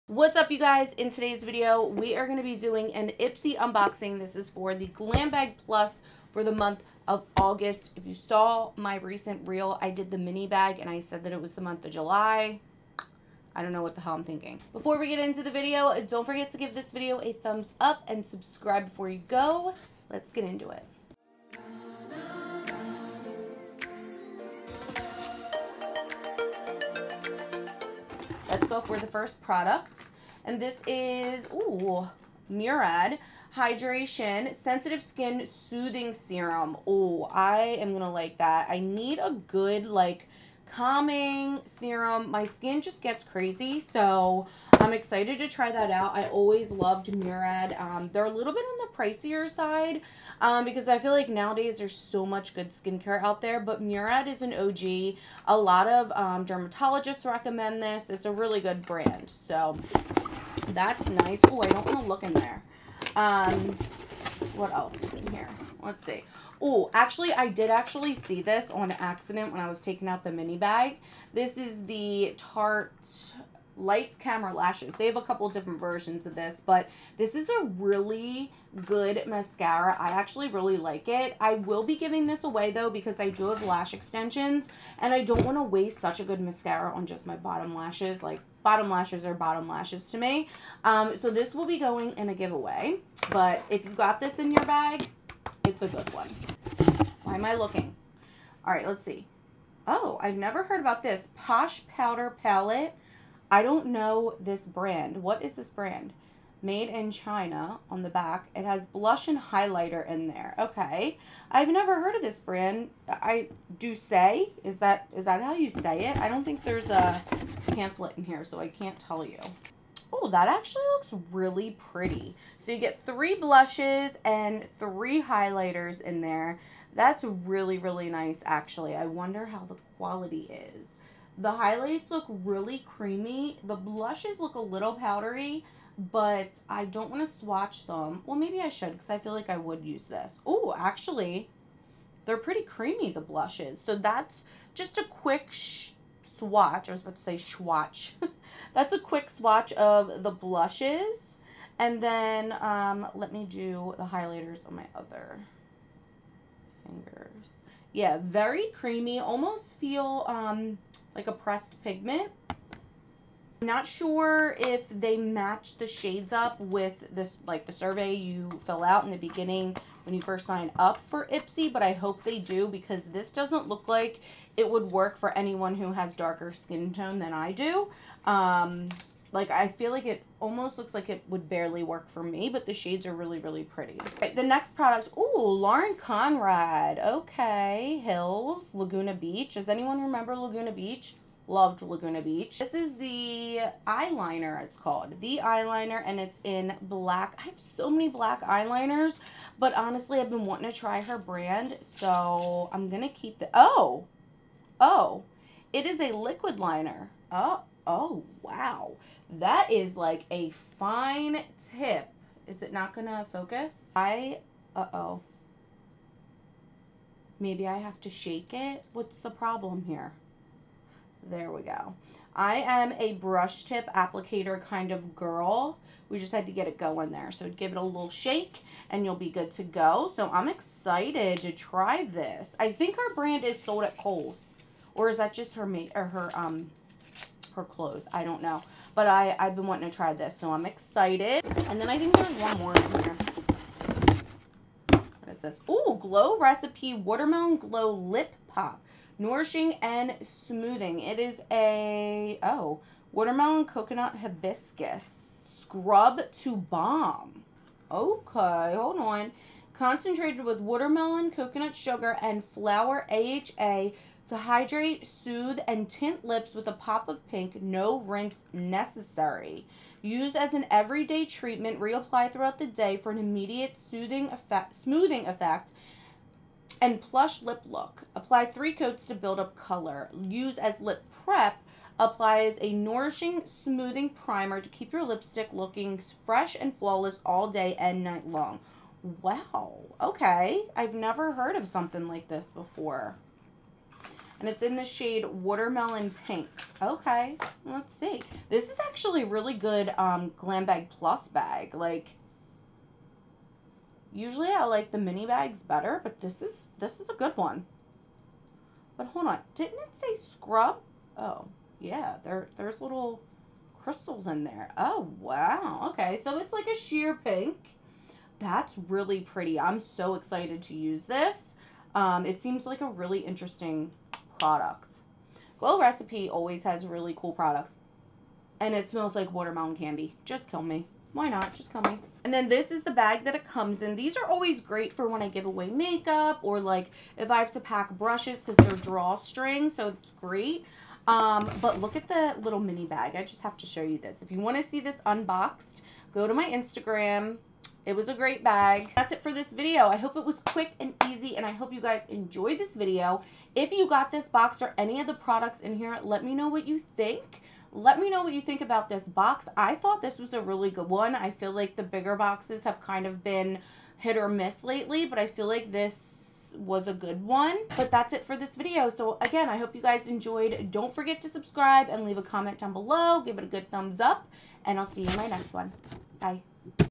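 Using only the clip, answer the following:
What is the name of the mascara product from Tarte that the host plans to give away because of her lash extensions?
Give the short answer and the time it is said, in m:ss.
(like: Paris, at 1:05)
Lights Camera Lashes, at 1:13.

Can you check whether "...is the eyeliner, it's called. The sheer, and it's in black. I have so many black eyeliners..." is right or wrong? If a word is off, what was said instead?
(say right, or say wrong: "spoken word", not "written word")
wrong: "eyeliner", not "sheer".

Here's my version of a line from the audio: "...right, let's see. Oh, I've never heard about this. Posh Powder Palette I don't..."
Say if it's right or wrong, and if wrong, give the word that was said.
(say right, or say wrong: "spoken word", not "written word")
right.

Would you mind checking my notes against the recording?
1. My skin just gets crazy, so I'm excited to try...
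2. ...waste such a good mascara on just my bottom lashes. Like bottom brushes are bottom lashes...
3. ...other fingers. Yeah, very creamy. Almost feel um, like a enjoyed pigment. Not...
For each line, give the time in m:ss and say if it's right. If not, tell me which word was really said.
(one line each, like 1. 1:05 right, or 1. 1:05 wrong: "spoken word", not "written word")
1. 0:42 right
2. 1:25 wrong: "lashes", not "brushes"
3. 2:34 wrong: "pressed", not "enjoyed".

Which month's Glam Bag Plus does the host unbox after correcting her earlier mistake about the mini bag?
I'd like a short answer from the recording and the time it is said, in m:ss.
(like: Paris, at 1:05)
August, at 0:07.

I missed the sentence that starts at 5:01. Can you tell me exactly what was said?
Like, usually I like the mini bags better, but this is, this is a good one.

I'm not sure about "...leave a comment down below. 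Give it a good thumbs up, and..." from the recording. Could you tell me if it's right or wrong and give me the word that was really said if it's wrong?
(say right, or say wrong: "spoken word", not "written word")
right.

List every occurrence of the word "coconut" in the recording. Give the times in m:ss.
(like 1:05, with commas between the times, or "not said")
4:13, 4:21.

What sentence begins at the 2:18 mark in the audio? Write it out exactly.
Well, maybe I should because I feel like I would use this.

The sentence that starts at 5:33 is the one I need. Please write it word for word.
These are always great for when I give away makeup or like if I have to pack brushes because they're drawstring.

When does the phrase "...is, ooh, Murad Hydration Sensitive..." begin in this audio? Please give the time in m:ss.
0:30.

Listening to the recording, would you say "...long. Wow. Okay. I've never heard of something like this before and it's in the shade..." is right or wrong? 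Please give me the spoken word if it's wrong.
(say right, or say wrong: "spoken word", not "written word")
right.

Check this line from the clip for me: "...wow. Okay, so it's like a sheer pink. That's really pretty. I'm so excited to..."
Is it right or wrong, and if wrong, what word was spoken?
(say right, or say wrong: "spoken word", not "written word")
right.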